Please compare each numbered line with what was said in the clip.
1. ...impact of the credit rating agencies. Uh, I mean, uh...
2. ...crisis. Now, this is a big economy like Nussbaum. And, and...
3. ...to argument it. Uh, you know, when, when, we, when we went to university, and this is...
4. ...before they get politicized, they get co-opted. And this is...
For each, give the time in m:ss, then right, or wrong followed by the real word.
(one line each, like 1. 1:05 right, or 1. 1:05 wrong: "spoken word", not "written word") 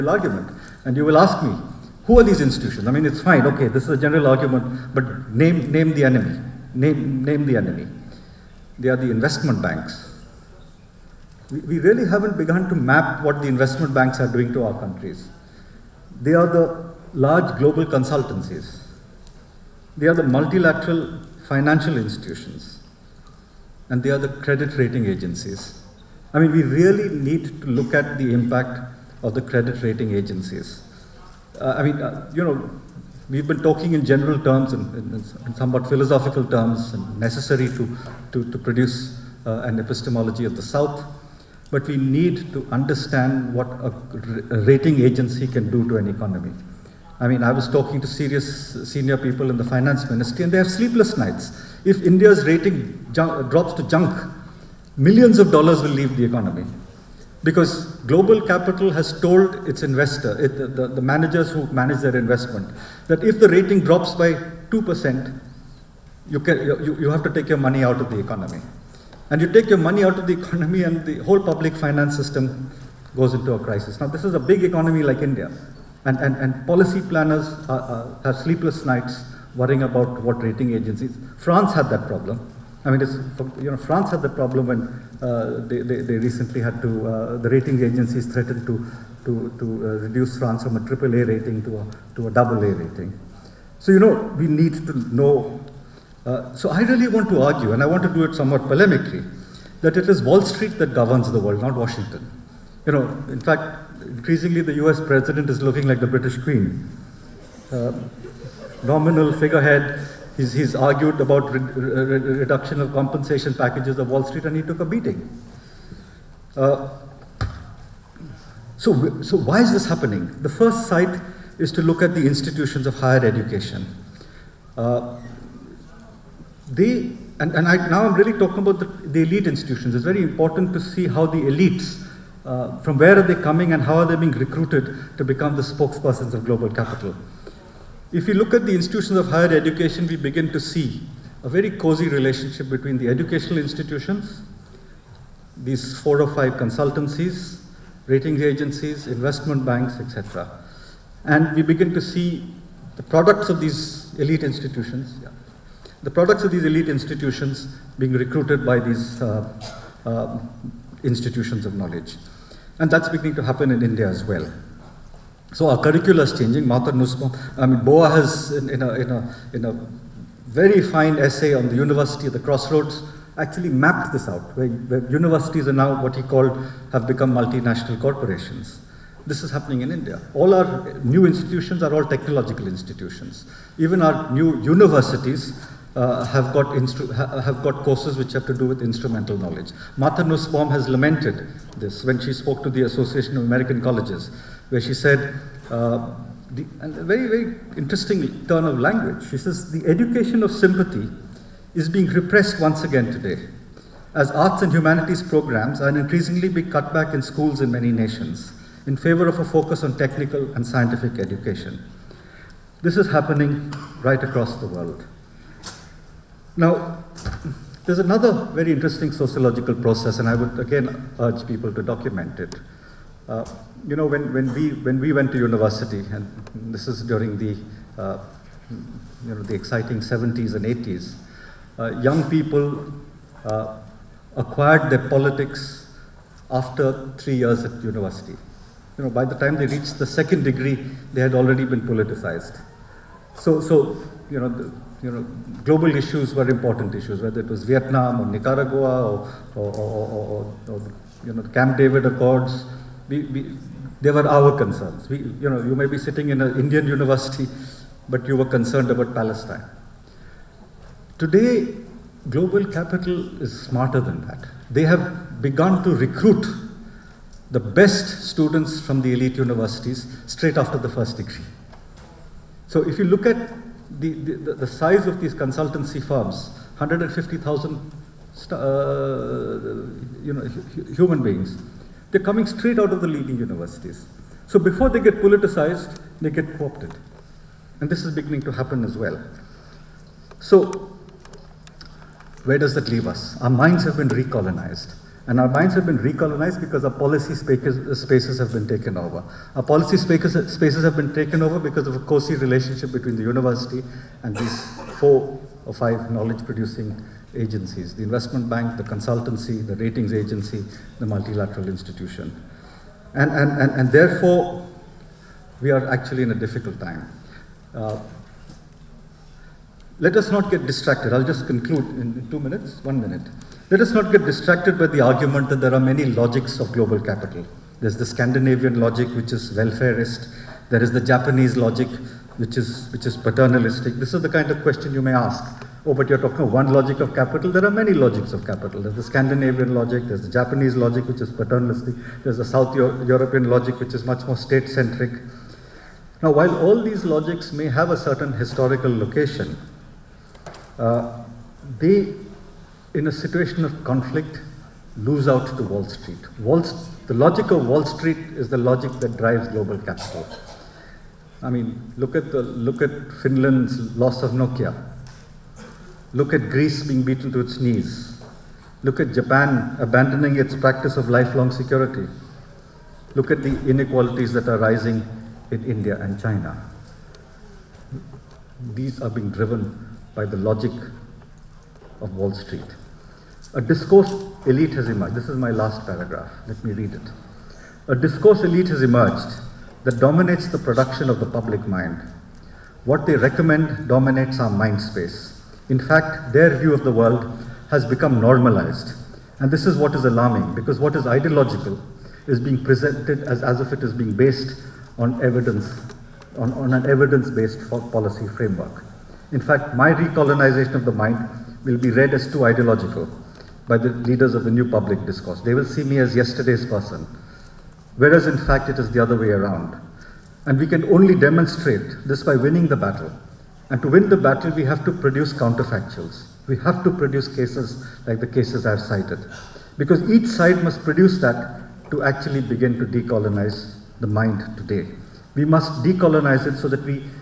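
1. 0:28 right
2. 1:13 wrong: "India", not "Nussbaum"
3. 3:41 wrong: "document", not "argument"
4. 4:44 right.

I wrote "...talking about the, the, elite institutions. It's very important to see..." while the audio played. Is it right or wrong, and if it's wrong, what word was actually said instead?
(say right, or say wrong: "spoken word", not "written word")
right.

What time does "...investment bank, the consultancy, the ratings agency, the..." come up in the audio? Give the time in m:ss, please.
5:08.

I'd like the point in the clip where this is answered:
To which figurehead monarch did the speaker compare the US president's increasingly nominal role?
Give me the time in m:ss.
1:46.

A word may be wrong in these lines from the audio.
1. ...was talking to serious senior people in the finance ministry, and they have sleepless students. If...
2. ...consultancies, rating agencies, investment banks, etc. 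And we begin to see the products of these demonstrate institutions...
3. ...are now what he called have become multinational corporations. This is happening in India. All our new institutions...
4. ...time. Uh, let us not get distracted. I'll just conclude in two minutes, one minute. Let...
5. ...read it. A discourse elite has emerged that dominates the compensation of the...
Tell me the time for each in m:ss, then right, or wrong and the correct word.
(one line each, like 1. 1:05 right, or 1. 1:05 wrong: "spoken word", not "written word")
1. 0:47 wrong: "nights", not "students"
2. 2:26 wrong: "elite", not "demonstrate"
3. 2:55 right
4. 5:16 right
5. 6:26 wrong: "production", not "compensation".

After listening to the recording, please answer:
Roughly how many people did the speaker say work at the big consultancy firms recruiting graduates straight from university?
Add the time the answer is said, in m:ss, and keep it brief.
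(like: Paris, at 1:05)
150,000, at 4:36.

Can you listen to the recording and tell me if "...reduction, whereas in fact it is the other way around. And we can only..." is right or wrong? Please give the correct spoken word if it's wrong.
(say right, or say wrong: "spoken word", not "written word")
wrong: "person", not "reduction".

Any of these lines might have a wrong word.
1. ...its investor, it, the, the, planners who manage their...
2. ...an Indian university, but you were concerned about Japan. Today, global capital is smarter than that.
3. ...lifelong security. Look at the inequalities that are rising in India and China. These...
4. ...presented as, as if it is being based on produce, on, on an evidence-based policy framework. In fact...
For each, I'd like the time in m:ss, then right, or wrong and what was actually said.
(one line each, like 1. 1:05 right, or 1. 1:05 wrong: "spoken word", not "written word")
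1. 0:59 wrong: "managers", not "planners"
2. 4:16 wrong: "Palestine", not "Japan"
3. 6:11 right
4. 6:42 wrong: "evidence", not "produce".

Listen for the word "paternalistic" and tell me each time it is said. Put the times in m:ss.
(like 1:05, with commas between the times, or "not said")
5:33, 5:41.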